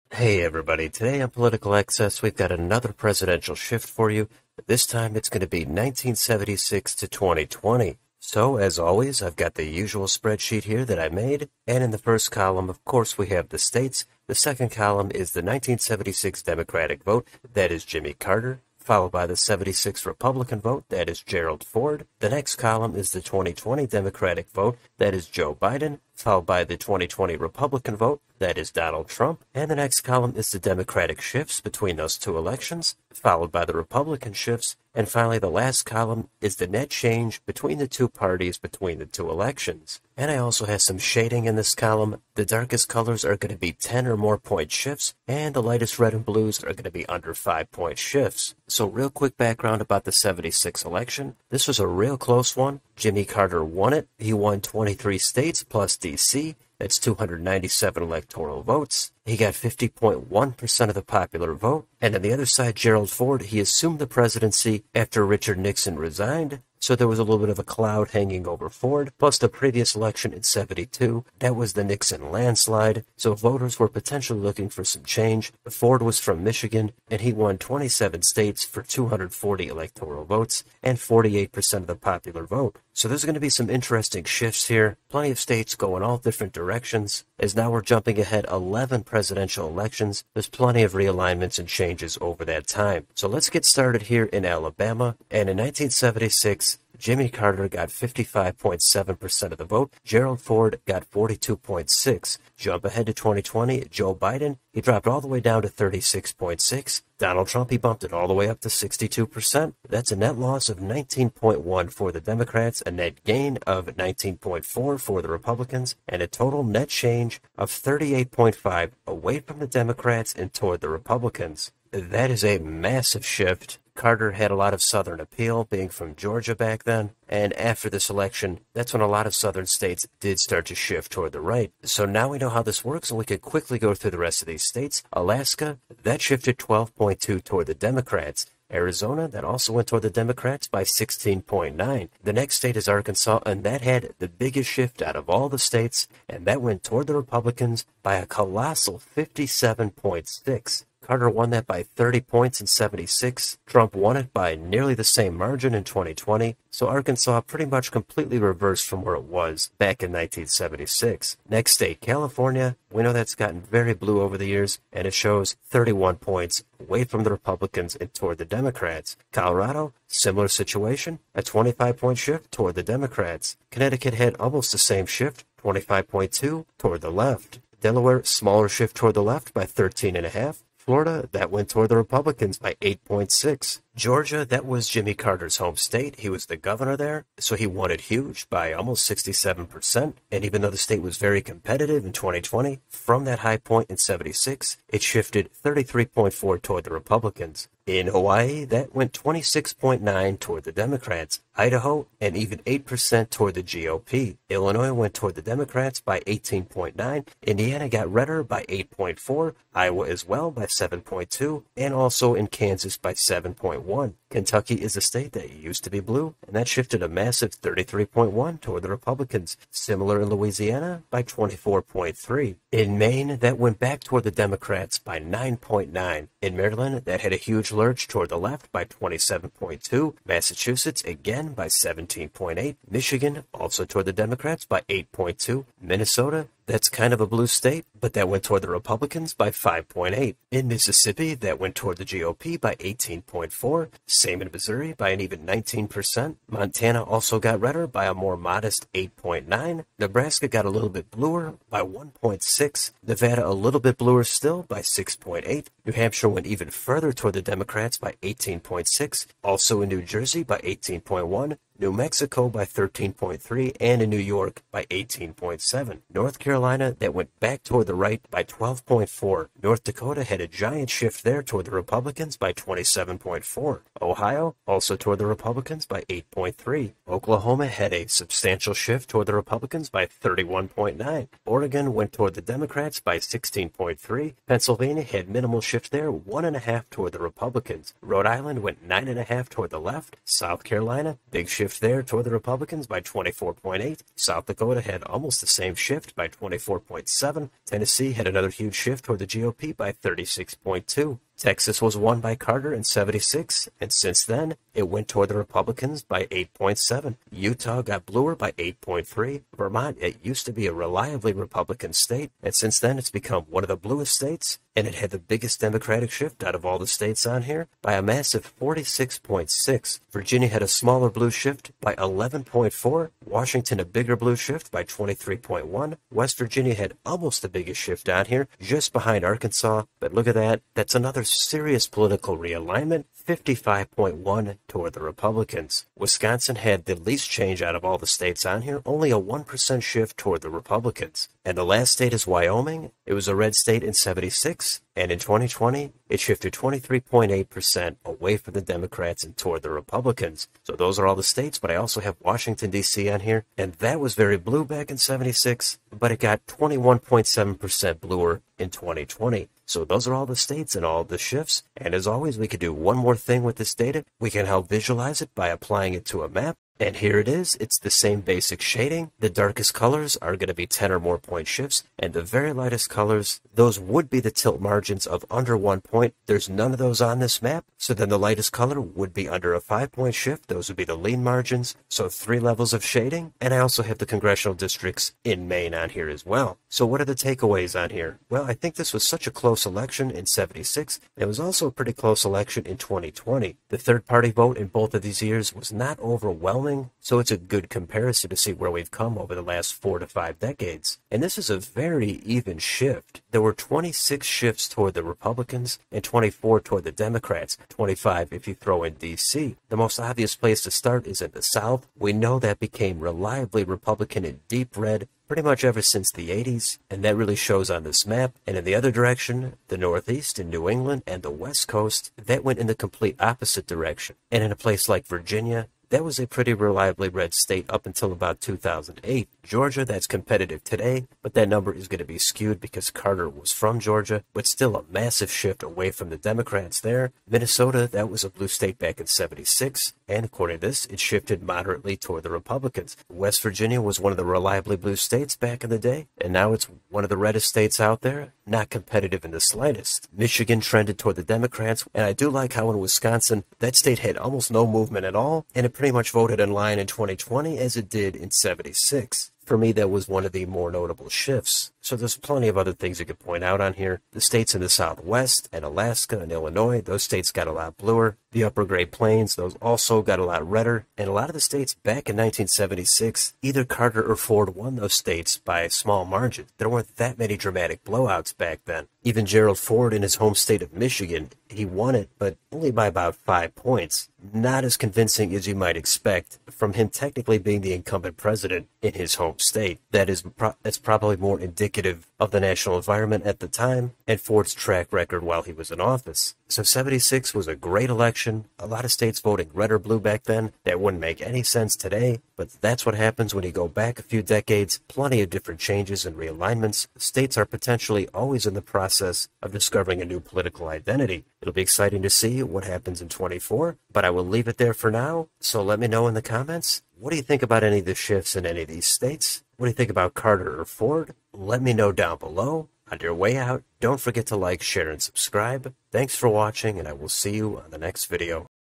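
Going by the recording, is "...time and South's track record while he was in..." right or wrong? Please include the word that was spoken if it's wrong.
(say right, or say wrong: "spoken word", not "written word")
wrong: "Ford", not "South".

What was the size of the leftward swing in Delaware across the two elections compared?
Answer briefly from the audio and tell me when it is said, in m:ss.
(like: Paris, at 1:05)
13.5, at 2:59.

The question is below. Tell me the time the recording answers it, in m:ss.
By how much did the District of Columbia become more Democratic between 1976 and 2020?
5:56.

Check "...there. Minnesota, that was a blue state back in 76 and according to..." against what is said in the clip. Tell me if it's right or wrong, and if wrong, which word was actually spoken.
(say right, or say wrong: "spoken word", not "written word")
right.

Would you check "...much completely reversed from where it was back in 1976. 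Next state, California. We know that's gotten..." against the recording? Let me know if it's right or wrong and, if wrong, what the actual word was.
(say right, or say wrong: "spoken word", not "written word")
right.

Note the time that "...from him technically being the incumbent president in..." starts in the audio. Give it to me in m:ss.
8:06.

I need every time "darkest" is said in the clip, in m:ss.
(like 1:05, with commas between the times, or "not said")
0:42, 6:09.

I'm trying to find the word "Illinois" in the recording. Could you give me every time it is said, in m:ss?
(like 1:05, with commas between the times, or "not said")
3:24, 7:46.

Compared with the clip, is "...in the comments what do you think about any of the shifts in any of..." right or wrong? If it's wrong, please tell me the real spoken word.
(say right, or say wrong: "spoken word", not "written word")
right.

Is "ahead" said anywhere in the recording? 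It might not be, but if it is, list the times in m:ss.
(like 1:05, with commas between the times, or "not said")
1:28, 1:42.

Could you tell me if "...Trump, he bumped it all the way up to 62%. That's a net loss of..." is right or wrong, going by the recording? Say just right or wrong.
right.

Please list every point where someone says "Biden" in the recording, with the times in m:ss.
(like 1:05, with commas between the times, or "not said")
0:25, 1:44.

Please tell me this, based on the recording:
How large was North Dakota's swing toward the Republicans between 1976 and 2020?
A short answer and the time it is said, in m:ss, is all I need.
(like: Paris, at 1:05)
27.4, at 4:32.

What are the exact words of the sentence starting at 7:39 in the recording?
For me, that was one of the more notable shifts.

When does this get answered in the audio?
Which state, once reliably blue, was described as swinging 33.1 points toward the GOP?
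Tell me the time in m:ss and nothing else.
3:34.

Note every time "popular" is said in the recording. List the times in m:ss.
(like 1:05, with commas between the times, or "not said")
1:01, 1:21.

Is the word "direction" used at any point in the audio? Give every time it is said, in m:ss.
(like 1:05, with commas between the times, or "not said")
1:26, 6:58, 7:03.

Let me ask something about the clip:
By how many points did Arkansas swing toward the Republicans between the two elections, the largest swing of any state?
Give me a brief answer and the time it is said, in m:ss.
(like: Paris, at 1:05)
57.6, at 2:29.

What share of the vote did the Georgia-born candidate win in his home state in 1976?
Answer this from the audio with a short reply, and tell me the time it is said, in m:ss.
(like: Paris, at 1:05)
almost 67%, at 3:08.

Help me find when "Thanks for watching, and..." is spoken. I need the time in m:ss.
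8:45.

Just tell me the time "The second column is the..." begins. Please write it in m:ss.
0:14.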